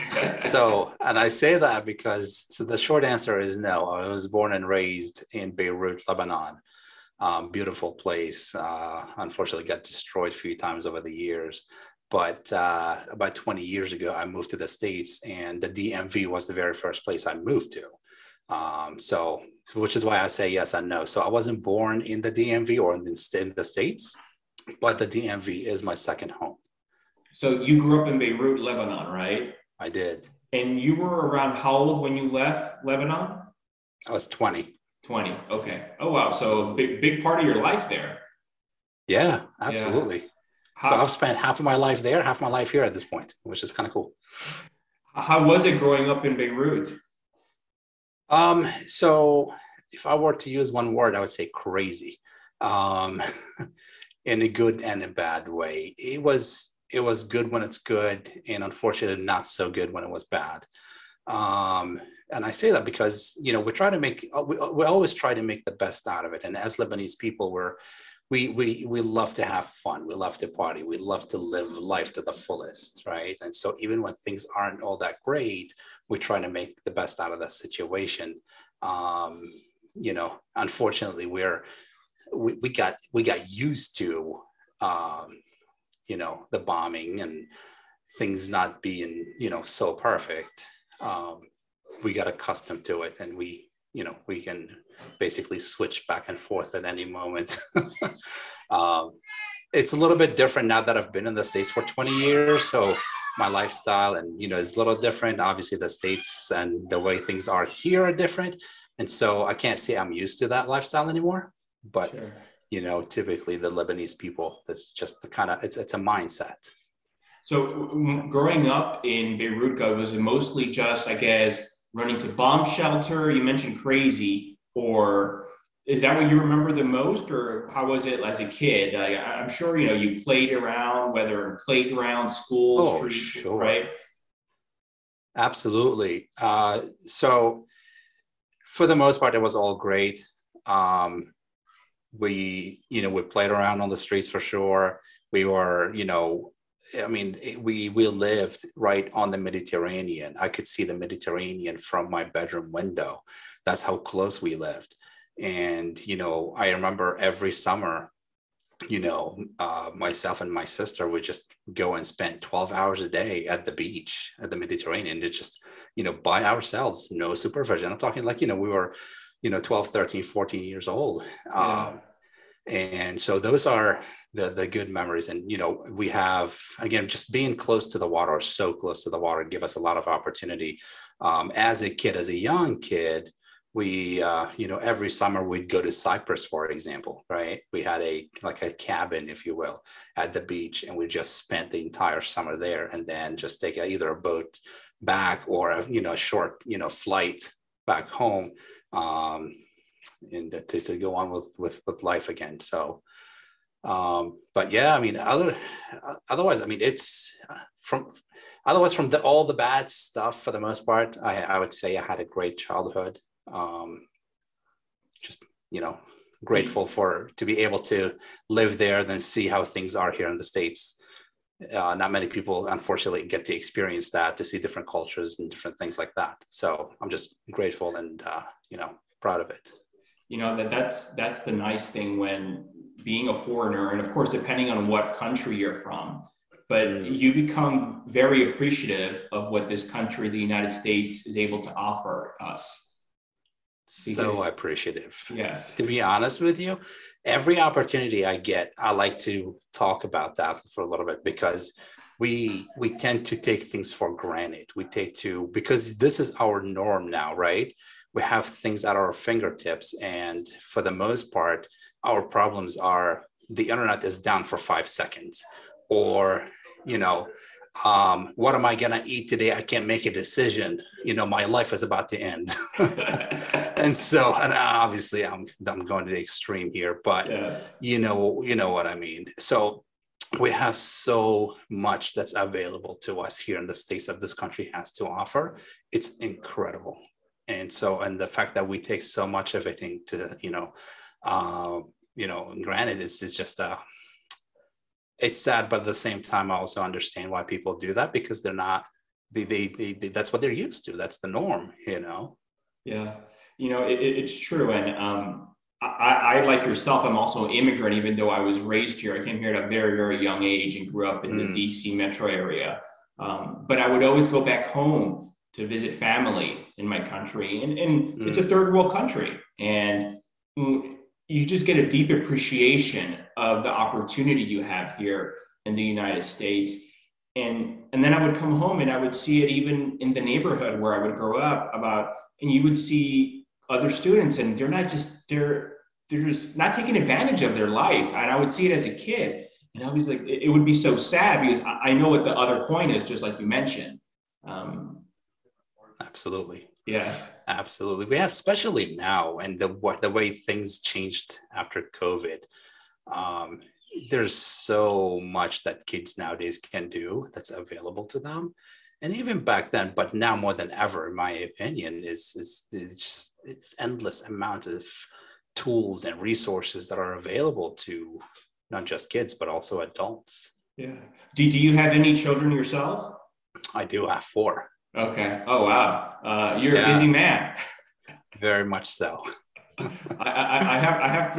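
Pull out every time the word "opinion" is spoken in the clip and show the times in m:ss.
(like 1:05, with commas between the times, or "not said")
6:01.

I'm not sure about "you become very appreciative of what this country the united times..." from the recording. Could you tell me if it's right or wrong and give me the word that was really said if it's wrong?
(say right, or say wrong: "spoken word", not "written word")
wrong: "states", not "times".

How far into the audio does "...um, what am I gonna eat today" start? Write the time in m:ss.
4:27.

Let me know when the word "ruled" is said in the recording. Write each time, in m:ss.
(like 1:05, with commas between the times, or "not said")
not said.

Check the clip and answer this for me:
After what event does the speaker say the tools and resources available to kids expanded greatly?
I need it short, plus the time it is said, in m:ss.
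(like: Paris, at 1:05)
Covid, at 5:51.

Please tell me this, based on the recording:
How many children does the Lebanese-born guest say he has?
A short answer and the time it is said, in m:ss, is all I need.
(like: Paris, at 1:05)
4, at 6:14.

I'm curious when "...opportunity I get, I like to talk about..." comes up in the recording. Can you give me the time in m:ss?
4:07.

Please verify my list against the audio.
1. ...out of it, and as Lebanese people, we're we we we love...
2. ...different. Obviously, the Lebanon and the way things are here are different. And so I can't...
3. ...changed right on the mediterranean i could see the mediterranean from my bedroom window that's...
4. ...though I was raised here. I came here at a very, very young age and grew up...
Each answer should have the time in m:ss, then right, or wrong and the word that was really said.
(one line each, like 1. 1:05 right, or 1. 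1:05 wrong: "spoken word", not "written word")
1. 1:06 right
2. 1:44 wrong: "States", not "Lebanon"
3. 2:28 wrong: "lived", not "changed"
4. 5:08 right.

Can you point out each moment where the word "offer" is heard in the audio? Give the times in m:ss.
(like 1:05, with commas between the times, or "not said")
4:01, 4:45.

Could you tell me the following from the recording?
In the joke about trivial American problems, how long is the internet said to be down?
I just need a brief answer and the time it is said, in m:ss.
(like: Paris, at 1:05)
5 seconds, at 4:24.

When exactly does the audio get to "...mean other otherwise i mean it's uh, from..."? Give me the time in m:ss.
3:24.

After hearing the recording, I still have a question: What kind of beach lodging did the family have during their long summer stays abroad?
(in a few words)
A cabin.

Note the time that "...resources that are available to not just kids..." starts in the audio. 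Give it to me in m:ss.
6:06.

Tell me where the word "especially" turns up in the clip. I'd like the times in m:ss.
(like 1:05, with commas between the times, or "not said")
5:48.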